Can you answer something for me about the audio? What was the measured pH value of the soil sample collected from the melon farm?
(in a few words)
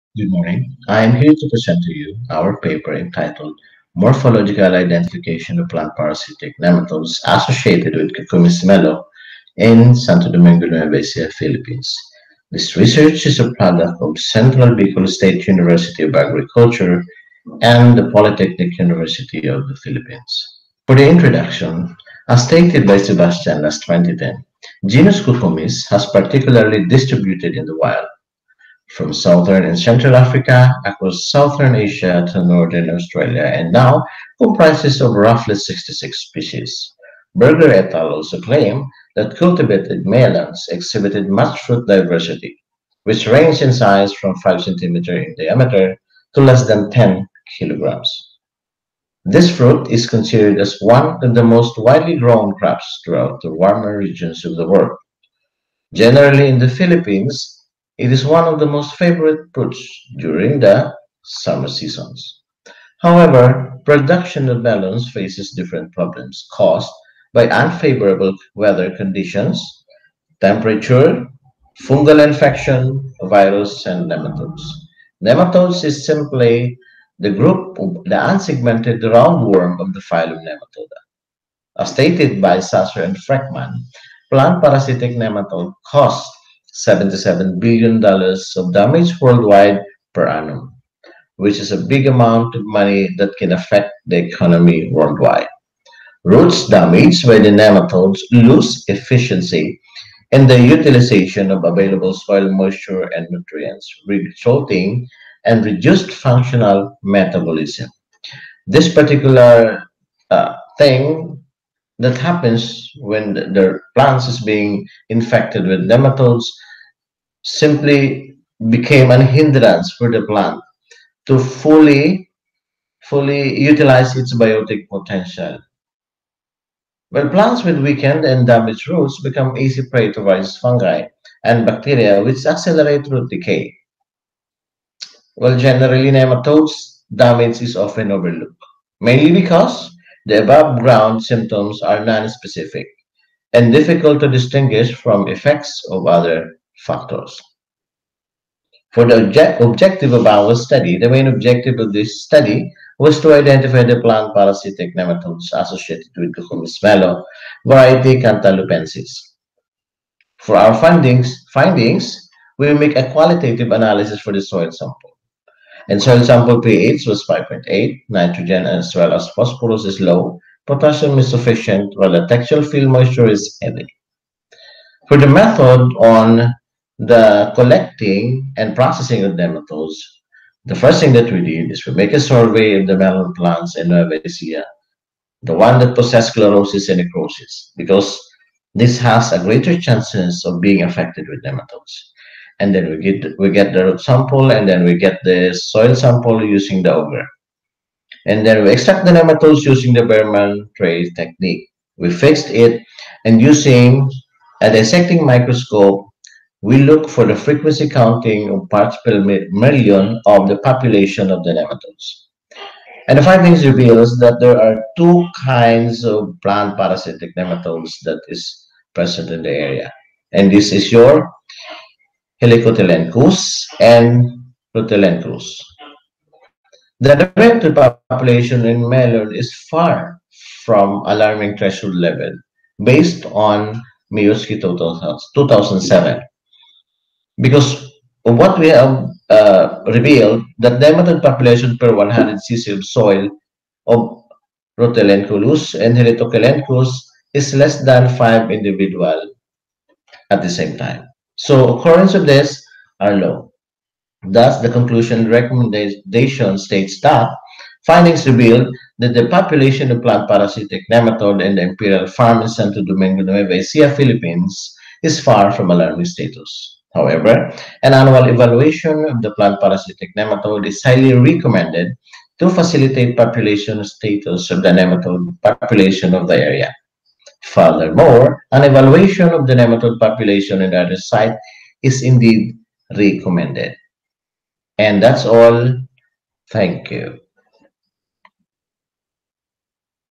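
5.8.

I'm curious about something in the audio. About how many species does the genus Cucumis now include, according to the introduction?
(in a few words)
66.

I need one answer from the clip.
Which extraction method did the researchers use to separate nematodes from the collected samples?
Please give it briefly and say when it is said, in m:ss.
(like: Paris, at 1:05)
Baermann tray technique, at 3:20.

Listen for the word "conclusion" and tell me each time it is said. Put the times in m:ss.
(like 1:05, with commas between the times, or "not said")
4:14.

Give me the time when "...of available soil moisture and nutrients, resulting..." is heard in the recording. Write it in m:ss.
1:41.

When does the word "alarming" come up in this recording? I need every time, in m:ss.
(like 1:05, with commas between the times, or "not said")
3:51, 4:25.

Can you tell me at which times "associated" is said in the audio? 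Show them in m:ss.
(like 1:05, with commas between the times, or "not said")
0:07, 2:35.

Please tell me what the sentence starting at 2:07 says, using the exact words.
When plants with weakened and damaged roots become easy prey to various fungi and bacteria which accelerate root decay.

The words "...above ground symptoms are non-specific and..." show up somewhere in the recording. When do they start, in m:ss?
2:20.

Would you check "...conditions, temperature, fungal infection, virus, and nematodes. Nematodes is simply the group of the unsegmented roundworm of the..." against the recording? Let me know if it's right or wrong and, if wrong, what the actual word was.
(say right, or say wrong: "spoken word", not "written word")
right.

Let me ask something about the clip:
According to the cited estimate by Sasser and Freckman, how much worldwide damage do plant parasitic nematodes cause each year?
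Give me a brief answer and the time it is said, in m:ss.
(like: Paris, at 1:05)
$77 billion, at 1:26.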